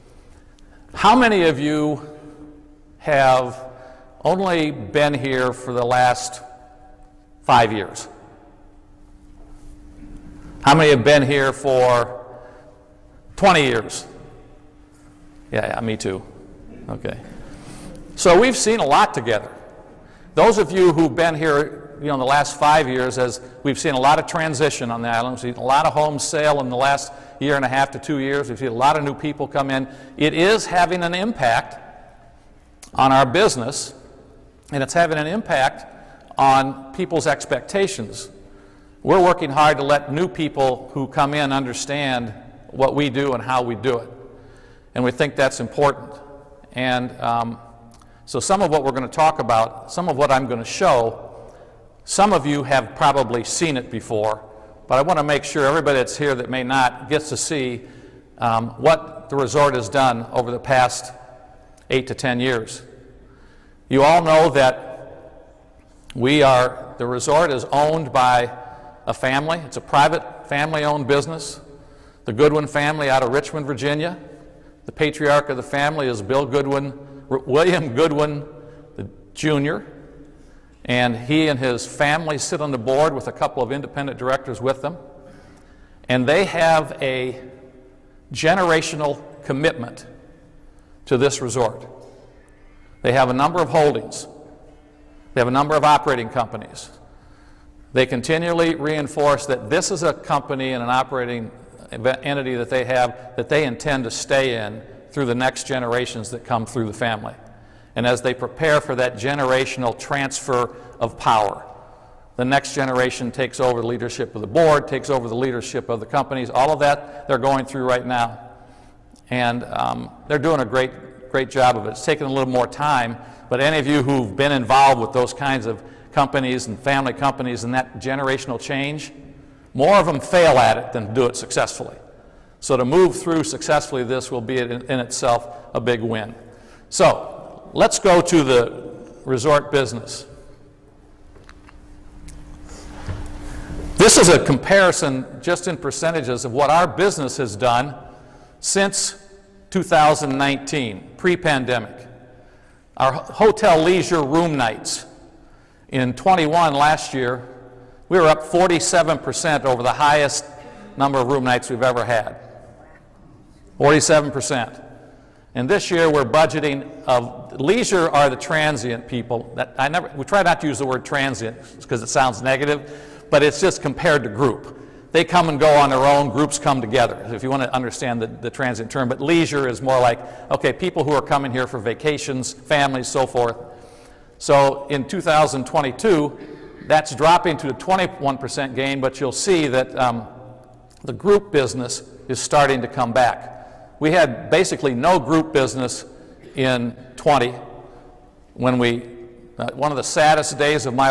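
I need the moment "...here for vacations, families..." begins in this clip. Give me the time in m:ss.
3:01.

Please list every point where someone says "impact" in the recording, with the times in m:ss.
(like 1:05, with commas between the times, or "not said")
0:31, 0:35.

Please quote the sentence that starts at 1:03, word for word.
You all know that we are, the resort is owned by a family.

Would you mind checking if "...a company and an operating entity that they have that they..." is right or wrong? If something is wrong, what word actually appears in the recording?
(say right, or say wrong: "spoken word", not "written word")
right.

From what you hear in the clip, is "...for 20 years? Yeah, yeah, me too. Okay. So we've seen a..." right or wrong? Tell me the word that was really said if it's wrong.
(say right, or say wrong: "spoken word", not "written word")
right.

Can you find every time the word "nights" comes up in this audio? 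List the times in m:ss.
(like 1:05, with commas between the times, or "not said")
2:34, 2:41.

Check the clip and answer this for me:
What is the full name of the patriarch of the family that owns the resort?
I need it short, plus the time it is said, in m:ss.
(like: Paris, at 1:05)
William Goodwin Jr., at 1:17.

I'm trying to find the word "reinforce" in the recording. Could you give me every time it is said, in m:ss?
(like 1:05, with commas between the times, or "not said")
1:38.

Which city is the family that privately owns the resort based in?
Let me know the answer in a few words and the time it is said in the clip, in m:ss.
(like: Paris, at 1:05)
Richmond, Virginia, at 1:13.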